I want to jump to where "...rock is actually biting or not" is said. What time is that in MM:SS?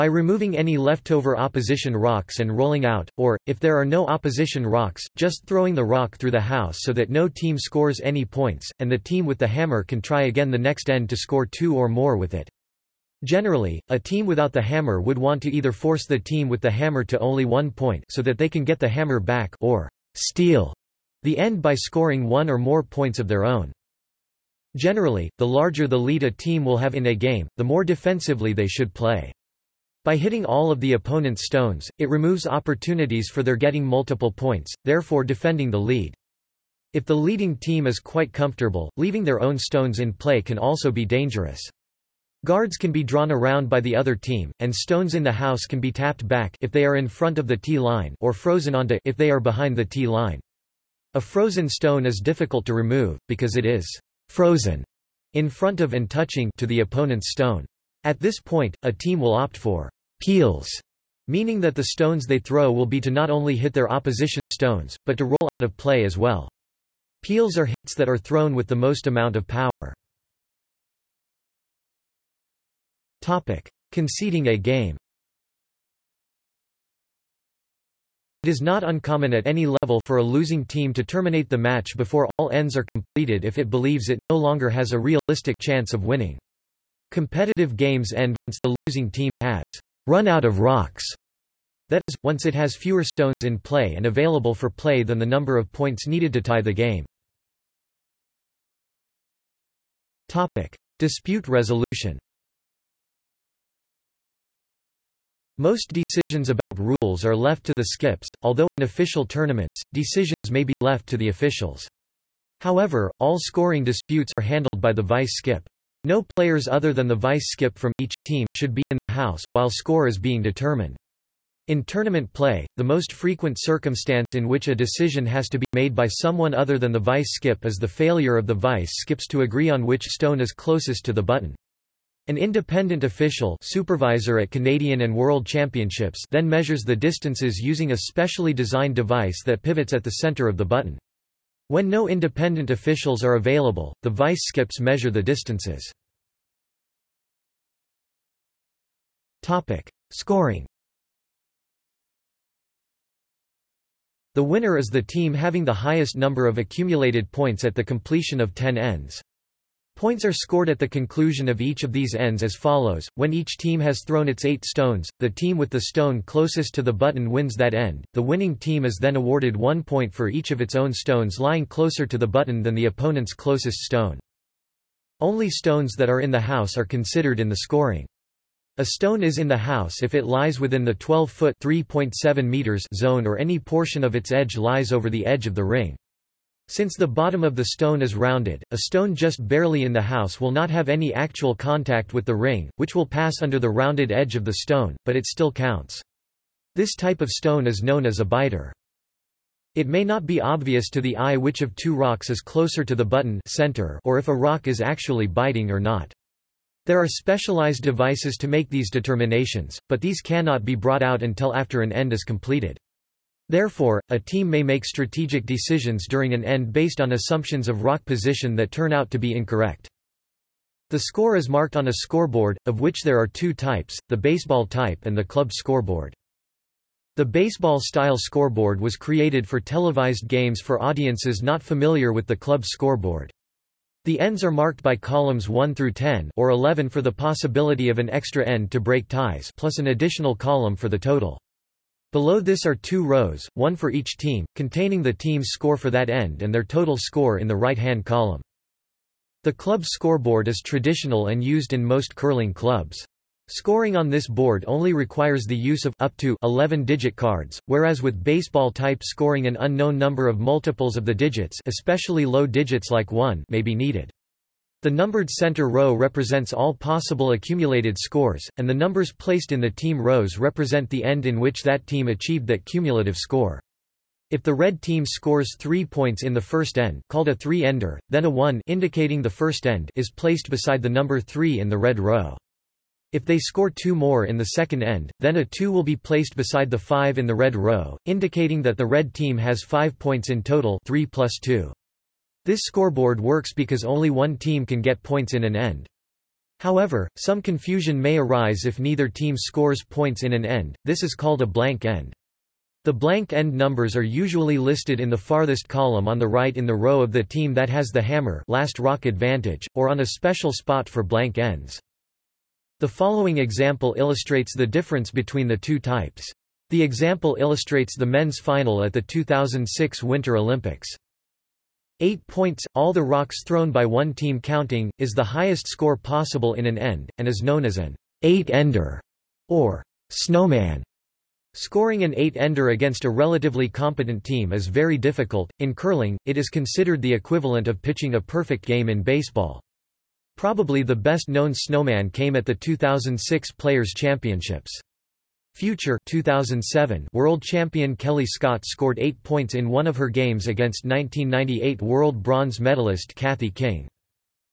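03:24.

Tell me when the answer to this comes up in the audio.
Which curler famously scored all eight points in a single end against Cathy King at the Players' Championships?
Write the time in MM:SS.
05:47.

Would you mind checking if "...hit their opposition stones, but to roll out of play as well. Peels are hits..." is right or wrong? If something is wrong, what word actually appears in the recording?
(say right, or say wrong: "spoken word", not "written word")
right.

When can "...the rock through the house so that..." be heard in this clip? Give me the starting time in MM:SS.
00:05.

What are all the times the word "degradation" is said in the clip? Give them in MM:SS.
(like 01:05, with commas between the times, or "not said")
not said.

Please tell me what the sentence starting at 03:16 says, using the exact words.
This type of stone is known as a biter.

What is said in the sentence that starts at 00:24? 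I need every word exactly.
Generally, the larger the lead a team will have in a game, the more defensively they should play.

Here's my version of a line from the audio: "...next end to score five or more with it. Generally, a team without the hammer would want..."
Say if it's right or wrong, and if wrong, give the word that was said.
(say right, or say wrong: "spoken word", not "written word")
wrong: "two", not "five".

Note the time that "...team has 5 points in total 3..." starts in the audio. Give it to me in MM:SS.
04:49.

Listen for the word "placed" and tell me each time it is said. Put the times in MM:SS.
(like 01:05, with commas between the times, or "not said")
04:29, 04:40, 04:45.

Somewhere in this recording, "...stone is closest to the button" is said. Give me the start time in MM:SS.
02:10.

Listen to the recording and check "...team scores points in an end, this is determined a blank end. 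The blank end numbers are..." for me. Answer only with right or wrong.
wrong.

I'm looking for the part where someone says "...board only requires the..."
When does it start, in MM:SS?
04:14.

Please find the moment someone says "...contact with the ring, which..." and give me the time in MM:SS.
03:11.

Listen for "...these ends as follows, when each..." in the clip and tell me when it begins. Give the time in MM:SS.
02:41.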